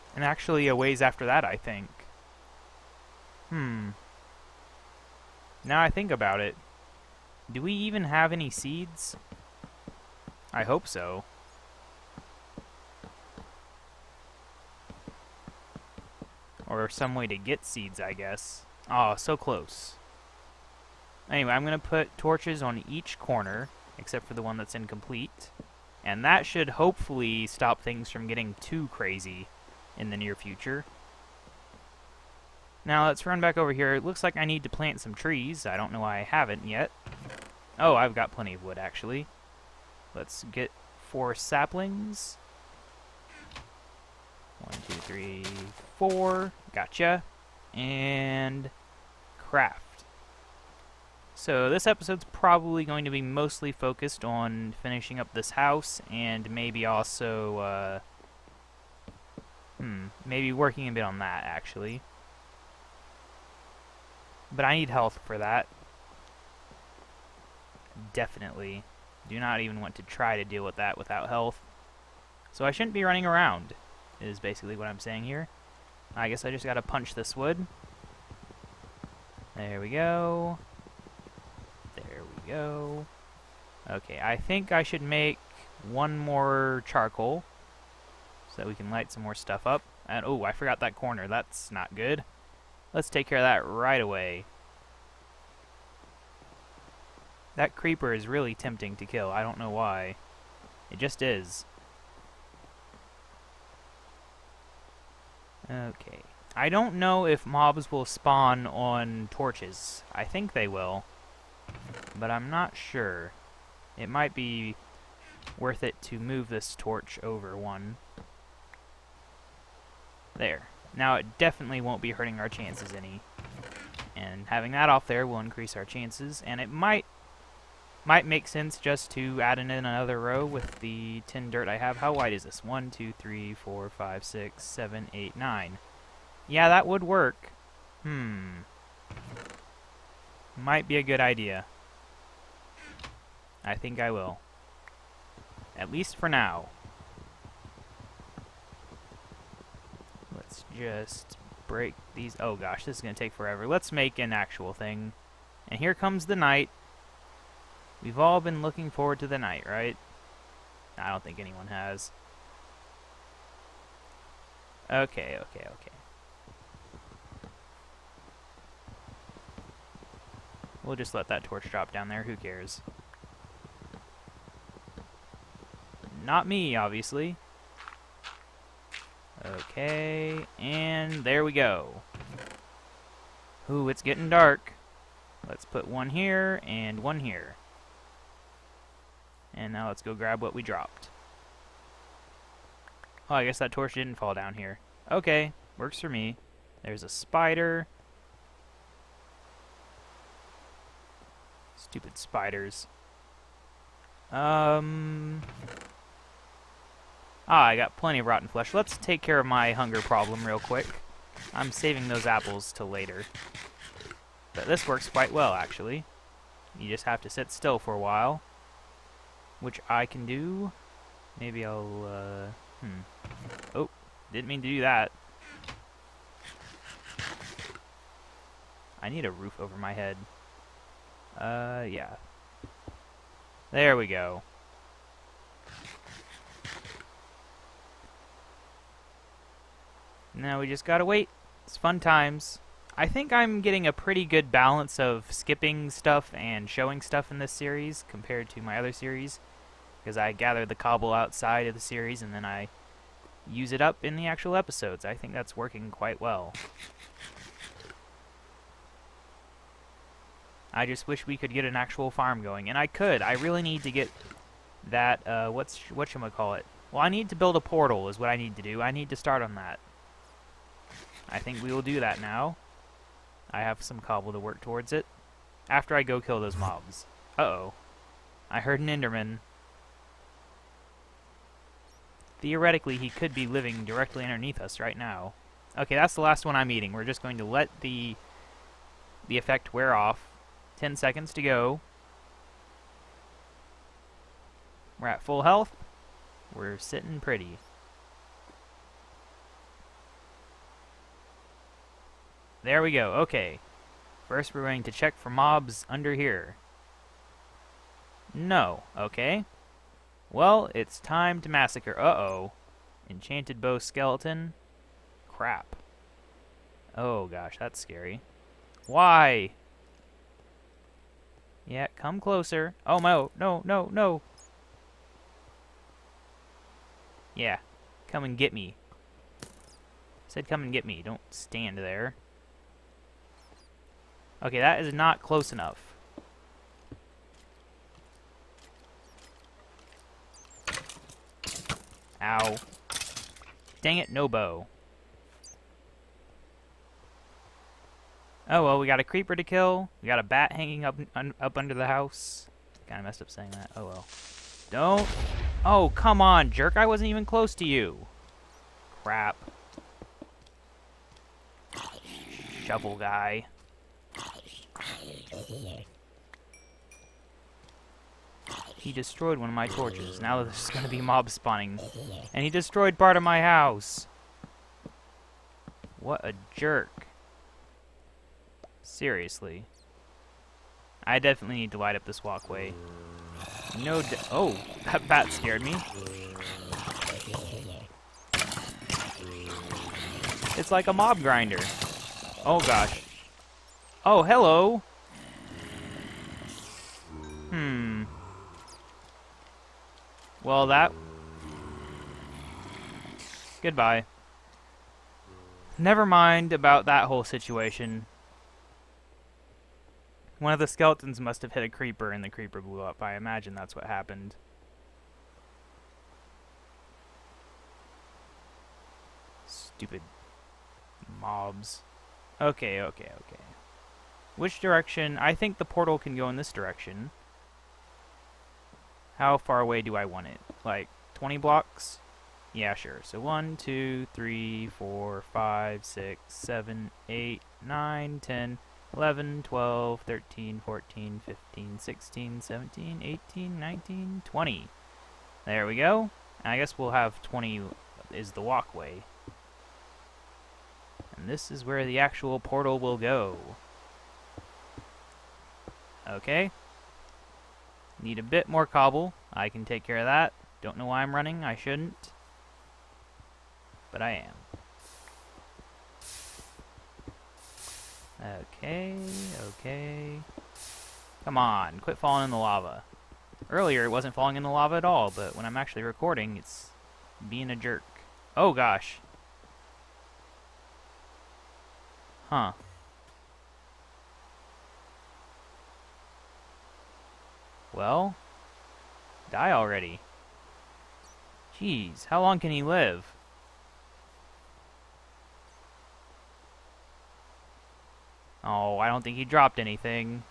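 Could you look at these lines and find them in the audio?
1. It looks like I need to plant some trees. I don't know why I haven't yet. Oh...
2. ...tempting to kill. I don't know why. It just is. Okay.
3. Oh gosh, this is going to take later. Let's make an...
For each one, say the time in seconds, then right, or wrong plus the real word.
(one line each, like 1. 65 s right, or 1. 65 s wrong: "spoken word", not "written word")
1. 33 s right
2. 98 s right
3. 152 s wrong: "forever", not "later".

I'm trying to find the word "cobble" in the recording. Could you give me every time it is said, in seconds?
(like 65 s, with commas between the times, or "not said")
250 s, 274 s, 458 s.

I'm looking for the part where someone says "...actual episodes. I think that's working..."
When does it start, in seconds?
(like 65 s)
254 s.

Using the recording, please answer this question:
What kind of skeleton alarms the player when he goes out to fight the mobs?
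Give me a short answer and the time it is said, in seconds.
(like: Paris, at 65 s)
enchanted bow skeleton, at 313 s.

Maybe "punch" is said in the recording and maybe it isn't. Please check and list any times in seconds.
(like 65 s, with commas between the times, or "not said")
76 s.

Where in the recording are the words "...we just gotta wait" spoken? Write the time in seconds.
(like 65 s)
240 s.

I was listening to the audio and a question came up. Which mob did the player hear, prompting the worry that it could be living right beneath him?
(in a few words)
Enderman.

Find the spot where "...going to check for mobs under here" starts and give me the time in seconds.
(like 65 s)
304 s.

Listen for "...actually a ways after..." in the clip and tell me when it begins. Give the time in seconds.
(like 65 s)
0 s.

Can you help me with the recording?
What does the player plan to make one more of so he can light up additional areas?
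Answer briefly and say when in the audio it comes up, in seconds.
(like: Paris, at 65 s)
charcoal, at 86 s.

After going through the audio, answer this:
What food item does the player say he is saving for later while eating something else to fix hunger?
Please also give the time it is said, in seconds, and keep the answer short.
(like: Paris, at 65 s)
apples, at 212 s.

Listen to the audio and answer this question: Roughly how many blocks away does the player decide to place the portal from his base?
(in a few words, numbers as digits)
20.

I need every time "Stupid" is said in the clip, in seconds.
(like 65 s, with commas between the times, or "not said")
201 s, 419 s.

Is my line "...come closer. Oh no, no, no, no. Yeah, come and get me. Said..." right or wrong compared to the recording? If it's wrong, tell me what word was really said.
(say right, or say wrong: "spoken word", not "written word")
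right.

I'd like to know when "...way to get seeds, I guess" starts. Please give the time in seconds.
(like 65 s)
17 s.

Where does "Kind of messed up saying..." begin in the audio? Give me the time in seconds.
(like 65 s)
352 s.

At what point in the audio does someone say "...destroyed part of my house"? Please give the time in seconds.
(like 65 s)
372 s.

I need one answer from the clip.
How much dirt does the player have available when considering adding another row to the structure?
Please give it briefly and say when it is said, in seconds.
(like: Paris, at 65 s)
10, at 131 s.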